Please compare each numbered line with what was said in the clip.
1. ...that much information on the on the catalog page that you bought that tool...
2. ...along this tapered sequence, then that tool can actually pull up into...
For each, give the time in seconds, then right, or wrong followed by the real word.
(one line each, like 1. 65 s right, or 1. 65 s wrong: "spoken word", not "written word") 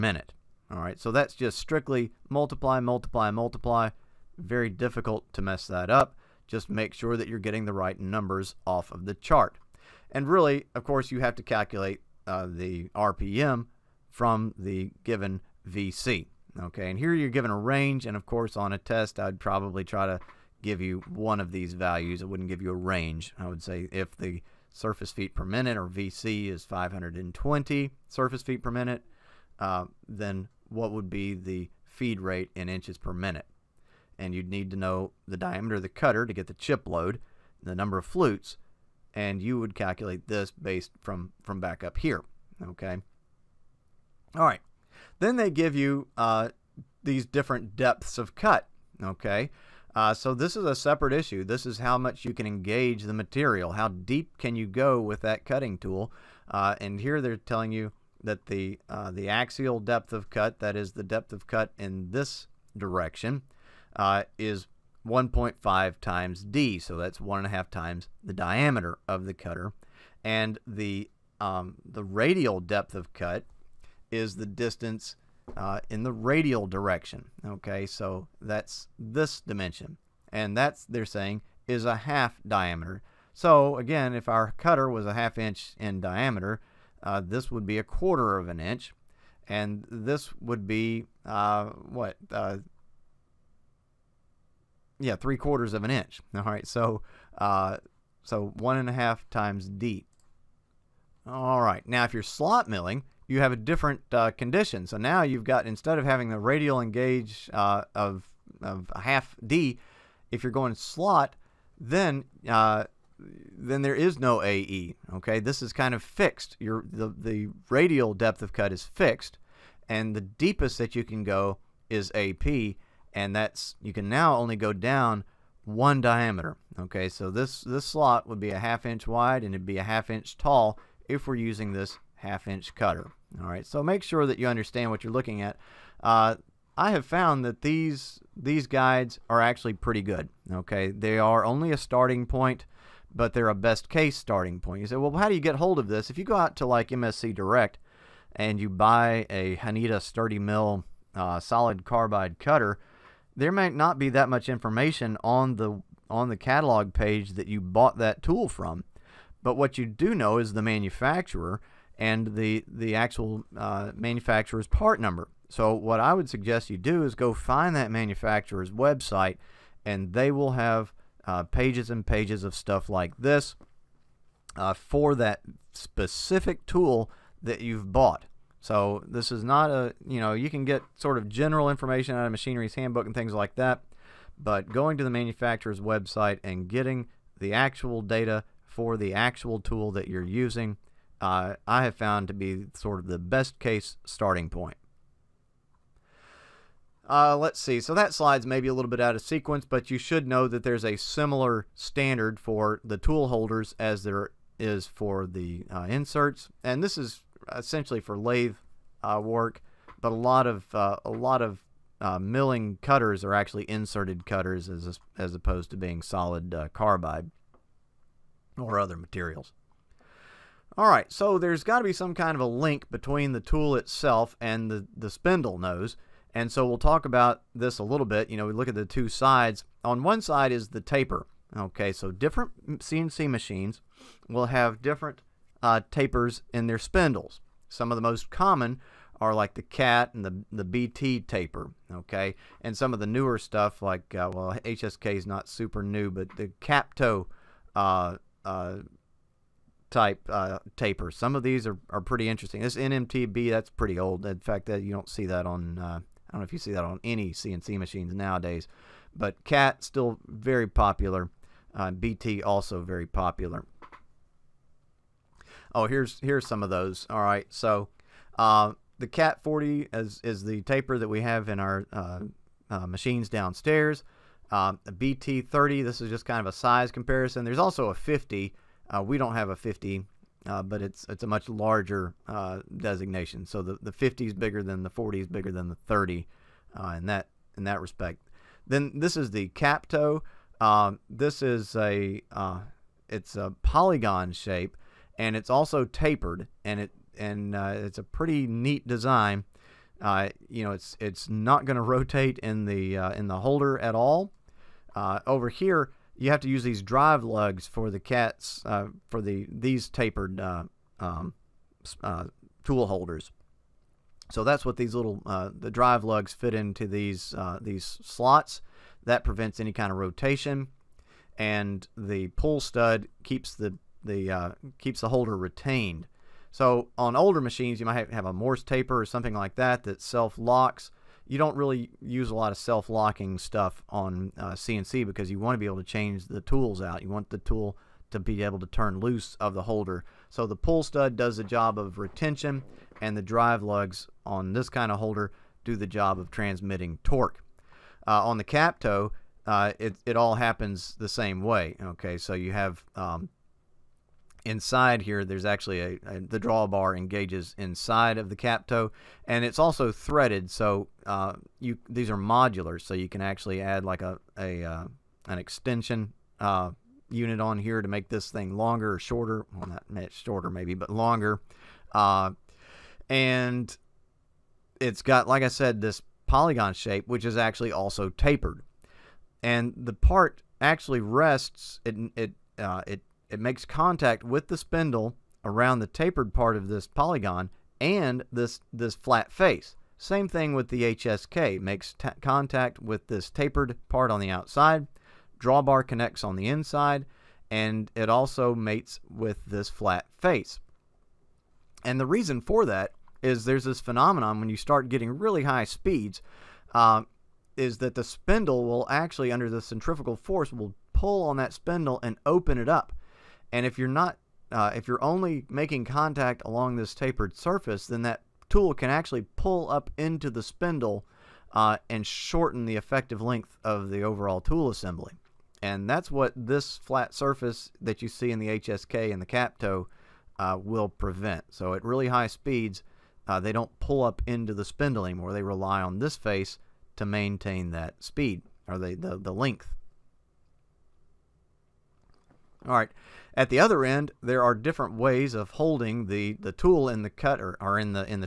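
1. 154 s right
2. 416 s wrong: "surface", not "sequence".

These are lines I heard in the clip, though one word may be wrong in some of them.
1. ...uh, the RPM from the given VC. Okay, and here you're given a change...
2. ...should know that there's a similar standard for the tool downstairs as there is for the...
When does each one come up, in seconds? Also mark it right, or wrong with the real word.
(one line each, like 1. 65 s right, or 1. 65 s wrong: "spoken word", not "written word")
1. 12 s wrong: "range", not "change"
2. 199 s wrong: "holders", not "downstairs".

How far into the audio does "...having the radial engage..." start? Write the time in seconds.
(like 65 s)
106 s.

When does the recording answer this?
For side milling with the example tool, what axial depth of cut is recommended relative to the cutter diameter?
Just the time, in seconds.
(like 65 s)
65 s.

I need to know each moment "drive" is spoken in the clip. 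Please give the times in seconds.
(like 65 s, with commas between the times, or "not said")
306 s, 315 s, 343 s.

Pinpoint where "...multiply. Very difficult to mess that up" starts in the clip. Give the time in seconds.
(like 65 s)
3 s.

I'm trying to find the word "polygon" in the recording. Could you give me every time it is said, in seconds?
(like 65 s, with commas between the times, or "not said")
293 s, 376 s, 386 s.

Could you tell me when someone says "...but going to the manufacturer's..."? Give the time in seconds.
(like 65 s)
184 s.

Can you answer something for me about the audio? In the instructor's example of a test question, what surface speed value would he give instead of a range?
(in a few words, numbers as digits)
520 surface feet per minute.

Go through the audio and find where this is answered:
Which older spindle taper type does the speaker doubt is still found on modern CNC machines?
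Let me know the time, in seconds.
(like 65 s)
252 s.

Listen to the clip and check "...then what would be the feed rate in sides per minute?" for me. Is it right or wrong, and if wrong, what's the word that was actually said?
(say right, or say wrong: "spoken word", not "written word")
wrong: "inches", not "sides".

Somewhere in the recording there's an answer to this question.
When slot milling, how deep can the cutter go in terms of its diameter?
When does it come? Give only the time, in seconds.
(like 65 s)
125 s.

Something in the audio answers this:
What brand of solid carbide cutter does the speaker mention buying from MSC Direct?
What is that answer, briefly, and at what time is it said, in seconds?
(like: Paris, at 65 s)
Haneda Sturdy Mill, at 149 s.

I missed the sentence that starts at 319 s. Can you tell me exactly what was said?
That prevents any kind of rotation, and the pull stud keeps the the uh, keeps the holder retained.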